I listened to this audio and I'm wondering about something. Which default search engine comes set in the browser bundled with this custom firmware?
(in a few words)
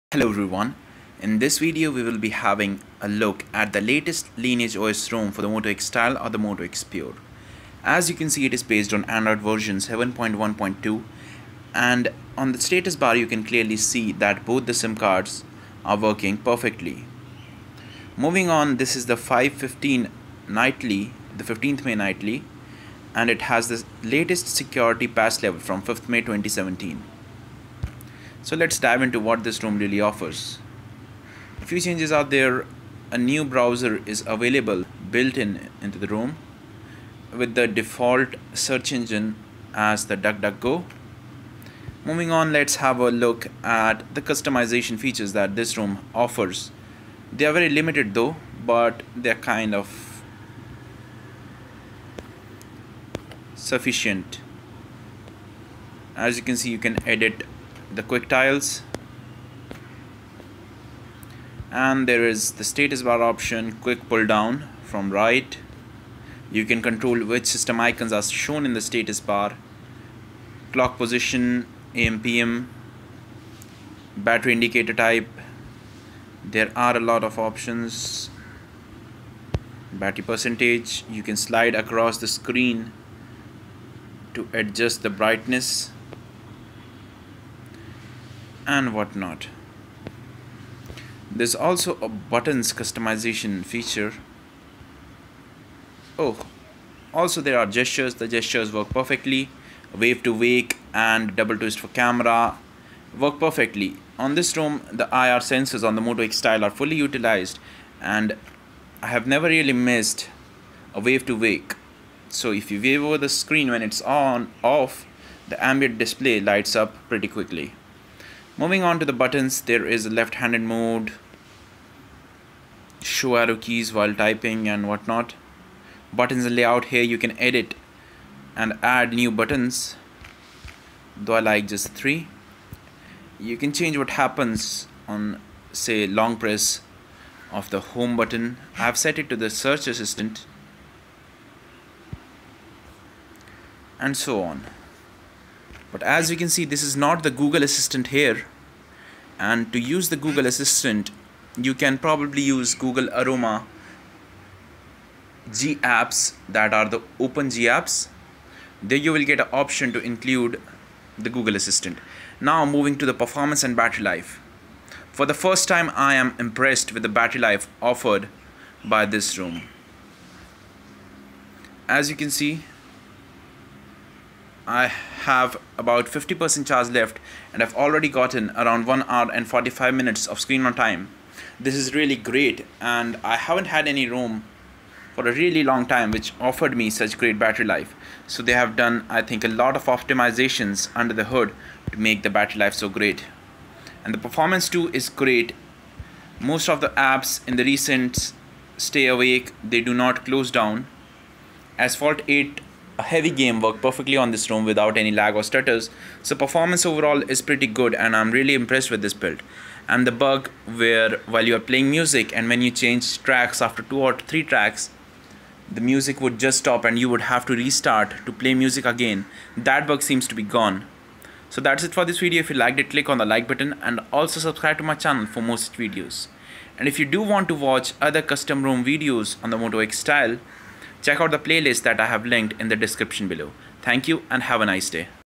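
DuckDuckGo.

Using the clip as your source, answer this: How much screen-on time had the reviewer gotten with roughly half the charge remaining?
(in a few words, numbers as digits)
1 hour and 45 minutes.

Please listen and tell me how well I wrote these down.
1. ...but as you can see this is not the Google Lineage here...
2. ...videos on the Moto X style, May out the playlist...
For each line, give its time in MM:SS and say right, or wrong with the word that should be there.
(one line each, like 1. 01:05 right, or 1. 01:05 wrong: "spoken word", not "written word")
1. 02:25 wrong: "Assistant", not "Lineage"
2. 03:48 wrong: "Check", not "May".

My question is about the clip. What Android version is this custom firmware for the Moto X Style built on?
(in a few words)
7.1.2.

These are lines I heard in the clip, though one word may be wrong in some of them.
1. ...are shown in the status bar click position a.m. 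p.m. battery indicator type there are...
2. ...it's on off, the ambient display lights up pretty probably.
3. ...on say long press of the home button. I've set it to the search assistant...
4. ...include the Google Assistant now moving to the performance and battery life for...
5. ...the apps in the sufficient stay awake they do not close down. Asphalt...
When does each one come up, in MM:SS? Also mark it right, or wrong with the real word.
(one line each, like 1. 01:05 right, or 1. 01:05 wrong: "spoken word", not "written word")
1. 01:08 wrong: "clock", not "click"
2. 01:53 wrong: "quickly", not "probably"
3. 02:15 right
4. 02:40 right
5. 03:16 wrong: "recent", not "sufficient".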